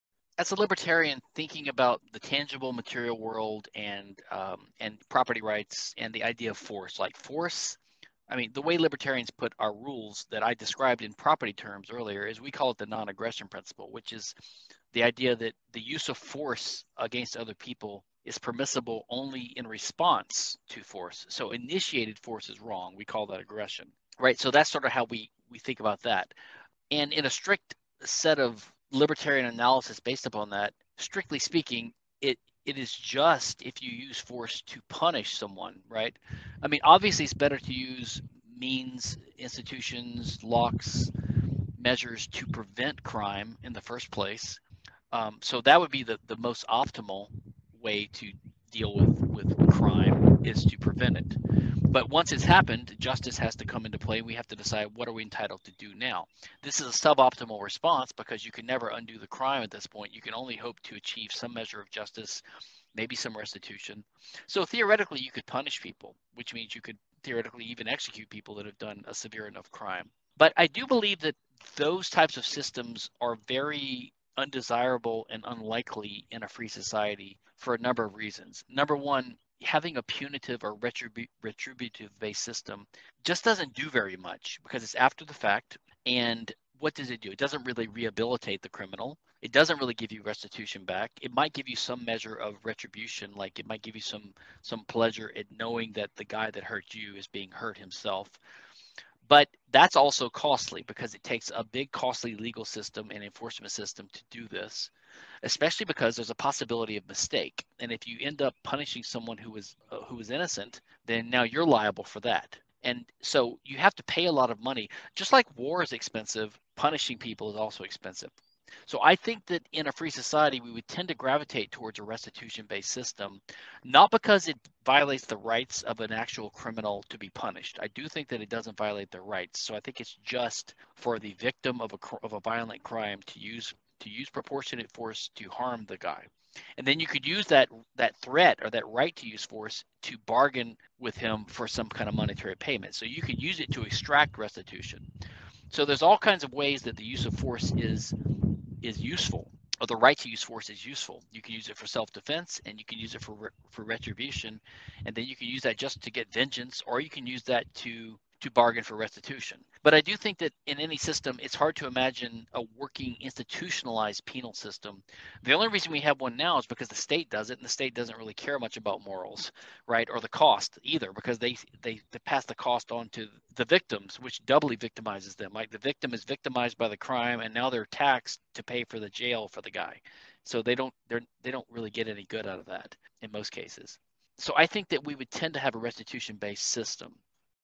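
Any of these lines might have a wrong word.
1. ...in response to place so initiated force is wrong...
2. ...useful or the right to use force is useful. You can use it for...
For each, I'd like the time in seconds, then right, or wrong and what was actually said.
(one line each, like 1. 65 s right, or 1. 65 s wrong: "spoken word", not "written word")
1. 19 s wrong: "force", not "place"
2. 148 s right.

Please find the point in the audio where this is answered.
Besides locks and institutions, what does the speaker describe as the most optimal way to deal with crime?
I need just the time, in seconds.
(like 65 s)
50 s.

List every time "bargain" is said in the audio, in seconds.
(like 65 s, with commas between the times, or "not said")
140 s, 158 s.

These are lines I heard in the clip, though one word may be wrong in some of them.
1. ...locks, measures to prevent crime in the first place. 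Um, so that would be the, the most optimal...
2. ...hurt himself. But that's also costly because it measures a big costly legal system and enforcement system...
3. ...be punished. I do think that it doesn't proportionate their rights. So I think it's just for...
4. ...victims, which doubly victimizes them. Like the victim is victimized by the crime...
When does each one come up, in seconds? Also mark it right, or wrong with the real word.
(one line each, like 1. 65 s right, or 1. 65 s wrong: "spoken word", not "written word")
1. 40 s right
2. 97 s wrong: "takes", not "measures"
3. 127 s wrong: "violate", not "proportionate"
4. 173 s right.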